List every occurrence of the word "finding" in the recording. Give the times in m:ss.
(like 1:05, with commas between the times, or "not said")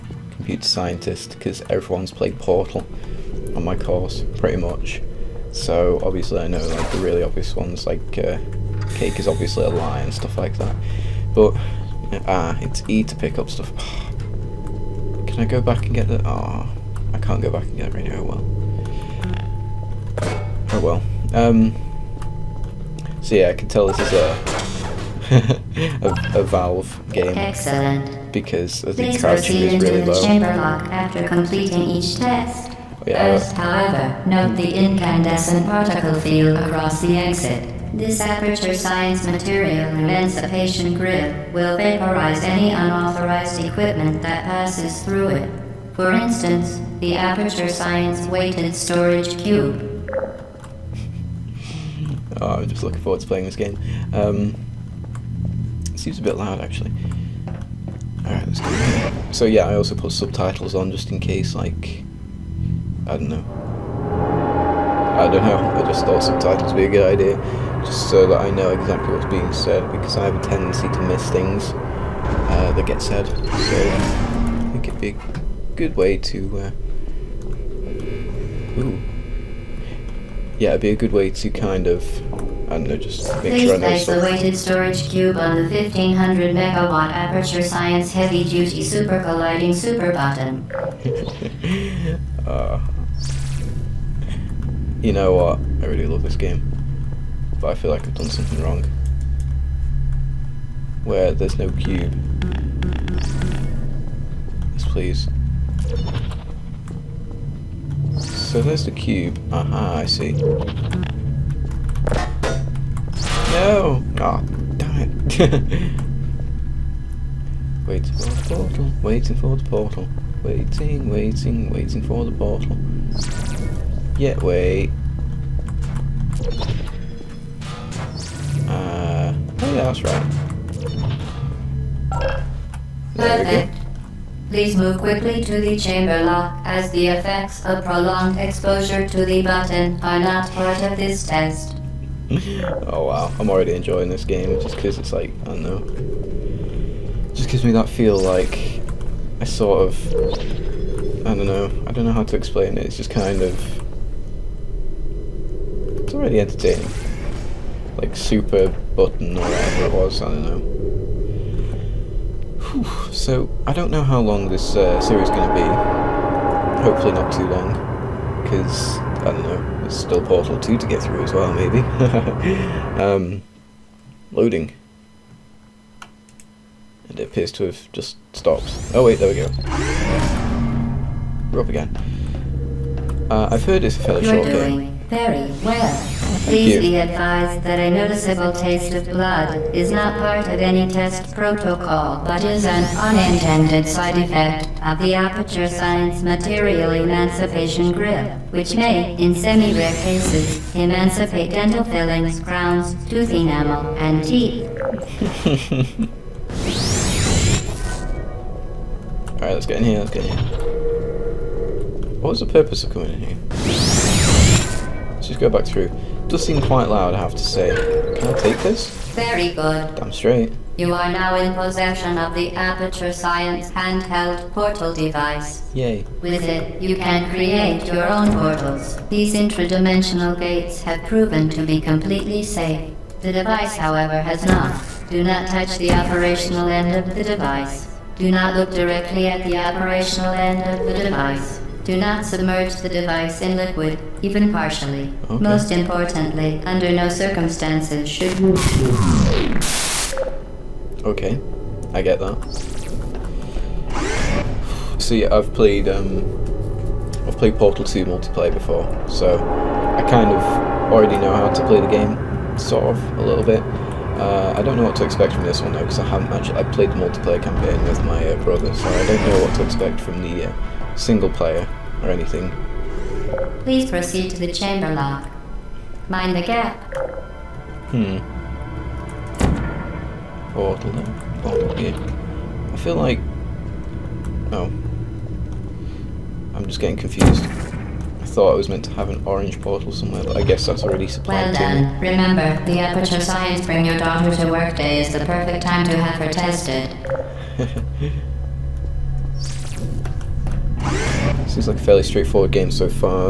not said.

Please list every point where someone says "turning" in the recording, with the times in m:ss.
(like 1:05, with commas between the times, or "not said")
not said.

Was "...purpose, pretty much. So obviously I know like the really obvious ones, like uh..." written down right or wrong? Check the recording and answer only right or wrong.
wrong.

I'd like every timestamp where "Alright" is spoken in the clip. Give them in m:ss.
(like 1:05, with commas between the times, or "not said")
0:58, 3:29.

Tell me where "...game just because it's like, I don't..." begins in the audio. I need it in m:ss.
2:24.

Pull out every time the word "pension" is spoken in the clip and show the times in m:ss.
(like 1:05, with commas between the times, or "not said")
not said.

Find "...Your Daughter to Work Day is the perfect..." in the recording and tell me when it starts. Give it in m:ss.
4:53.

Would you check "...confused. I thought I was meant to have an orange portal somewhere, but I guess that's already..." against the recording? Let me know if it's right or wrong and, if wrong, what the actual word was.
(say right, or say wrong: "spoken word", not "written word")
right.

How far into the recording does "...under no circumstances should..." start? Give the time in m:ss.
4:06.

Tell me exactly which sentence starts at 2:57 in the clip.
And it appears to have just stopped.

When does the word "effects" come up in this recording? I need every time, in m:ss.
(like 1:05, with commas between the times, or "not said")
2:17, 3:14.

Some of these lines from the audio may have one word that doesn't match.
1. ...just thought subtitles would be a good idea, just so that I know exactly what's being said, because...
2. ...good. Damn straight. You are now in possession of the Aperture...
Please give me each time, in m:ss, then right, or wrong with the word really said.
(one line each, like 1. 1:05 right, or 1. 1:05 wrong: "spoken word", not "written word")
1. 1:05 right
2. 3:39 right.